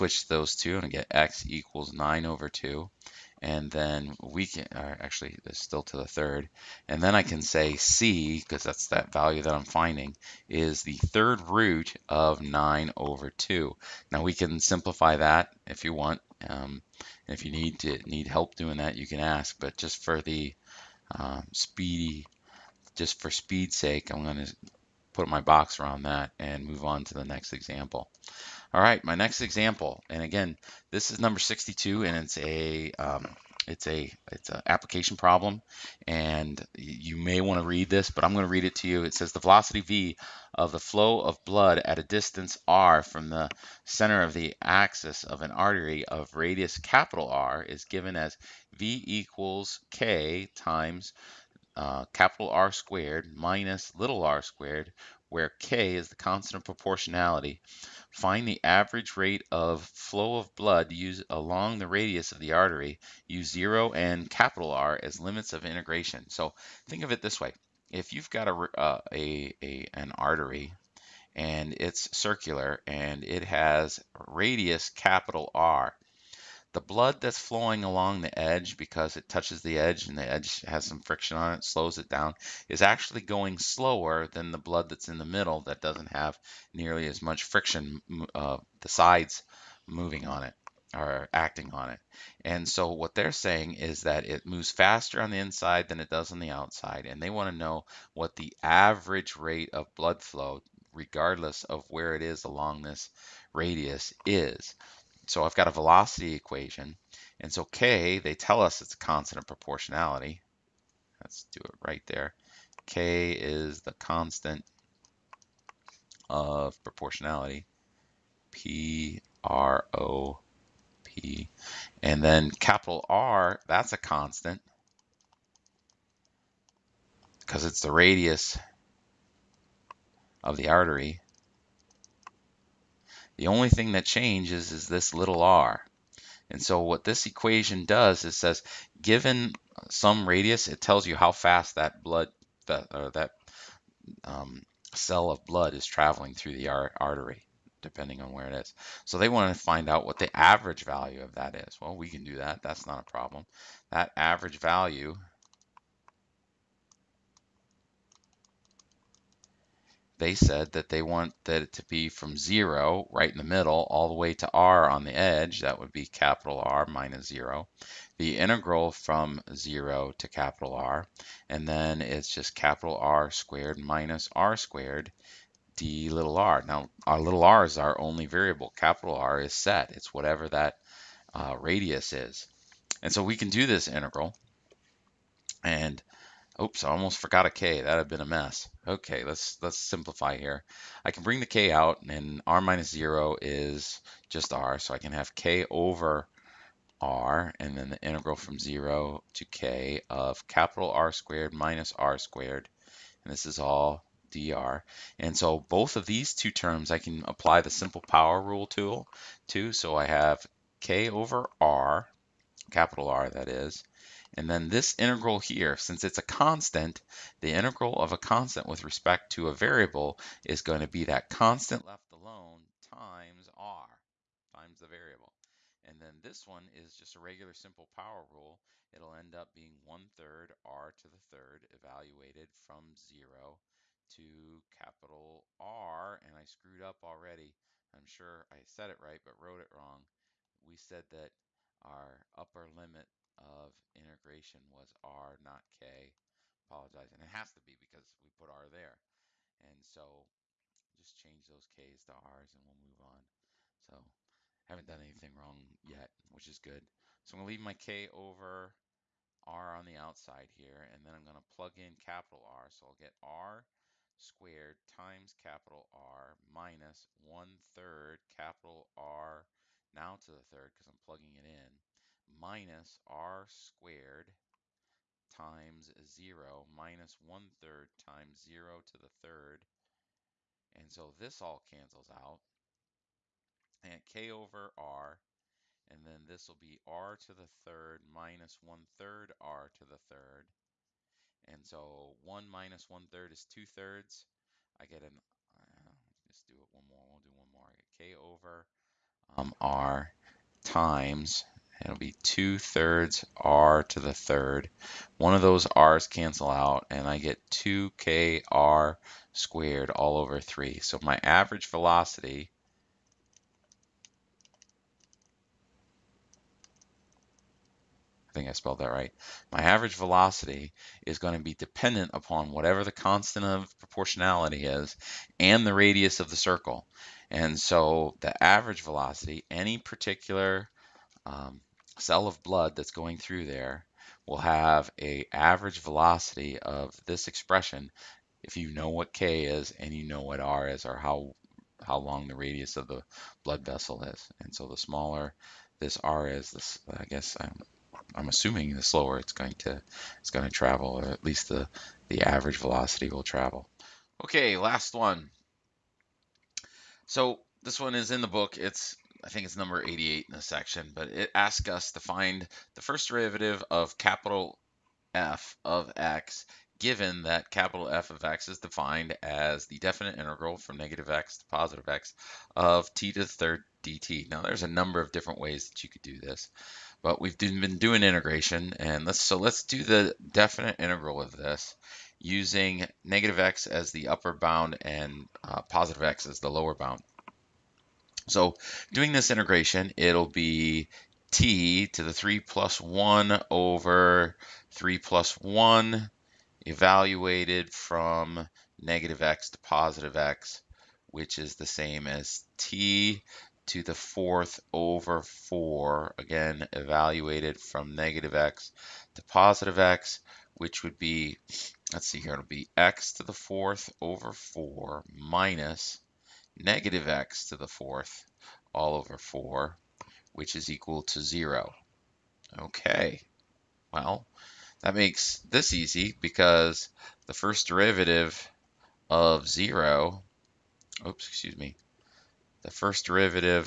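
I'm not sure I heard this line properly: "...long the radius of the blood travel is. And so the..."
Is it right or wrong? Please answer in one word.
wrong.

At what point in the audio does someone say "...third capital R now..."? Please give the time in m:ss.
4:27.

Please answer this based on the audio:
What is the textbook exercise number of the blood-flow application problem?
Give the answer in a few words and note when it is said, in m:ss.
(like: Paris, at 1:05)
62, at 0:31.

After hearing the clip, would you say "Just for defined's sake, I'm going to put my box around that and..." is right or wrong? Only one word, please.
wrong.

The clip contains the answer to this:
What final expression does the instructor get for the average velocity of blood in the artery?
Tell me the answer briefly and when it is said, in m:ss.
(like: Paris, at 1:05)
2kR²/3, at 5:07.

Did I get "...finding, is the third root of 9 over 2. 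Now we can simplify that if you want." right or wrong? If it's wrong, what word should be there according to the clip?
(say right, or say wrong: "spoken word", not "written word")
right.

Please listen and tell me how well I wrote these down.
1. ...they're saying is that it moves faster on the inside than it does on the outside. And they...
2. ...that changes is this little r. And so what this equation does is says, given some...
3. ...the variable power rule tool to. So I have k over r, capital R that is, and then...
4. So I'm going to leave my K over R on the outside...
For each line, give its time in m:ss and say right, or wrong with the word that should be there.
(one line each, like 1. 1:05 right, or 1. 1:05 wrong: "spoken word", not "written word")
1. 1:33 right
2. 2:13 right
3. 3:27 wrong: "simple", not "variable"
4. 4:17 right.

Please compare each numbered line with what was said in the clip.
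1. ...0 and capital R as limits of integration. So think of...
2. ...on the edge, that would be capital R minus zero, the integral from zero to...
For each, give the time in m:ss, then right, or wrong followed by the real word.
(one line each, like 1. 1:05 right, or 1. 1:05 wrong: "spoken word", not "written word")
1. 1:03 right
2. 2:44 right.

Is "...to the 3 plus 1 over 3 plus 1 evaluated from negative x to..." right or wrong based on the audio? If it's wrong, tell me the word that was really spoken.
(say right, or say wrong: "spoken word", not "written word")
right.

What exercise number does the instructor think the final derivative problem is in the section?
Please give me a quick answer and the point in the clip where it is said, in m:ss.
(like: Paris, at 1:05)
88, at 5:59.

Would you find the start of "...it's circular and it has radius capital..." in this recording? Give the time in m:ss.
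1:11.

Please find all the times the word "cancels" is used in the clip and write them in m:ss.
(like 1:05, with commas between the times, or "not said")
4:41, 5:06.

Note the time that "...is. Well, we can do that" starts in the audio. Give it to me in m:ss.
2:31.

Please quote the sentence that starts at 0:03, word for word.
And then we can, actually, it's still to the third.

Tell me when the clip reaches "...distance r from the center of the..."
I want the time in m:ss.
0:42.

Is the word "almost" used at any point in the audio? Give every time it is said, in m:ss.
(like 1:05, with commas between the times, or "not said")
3:06.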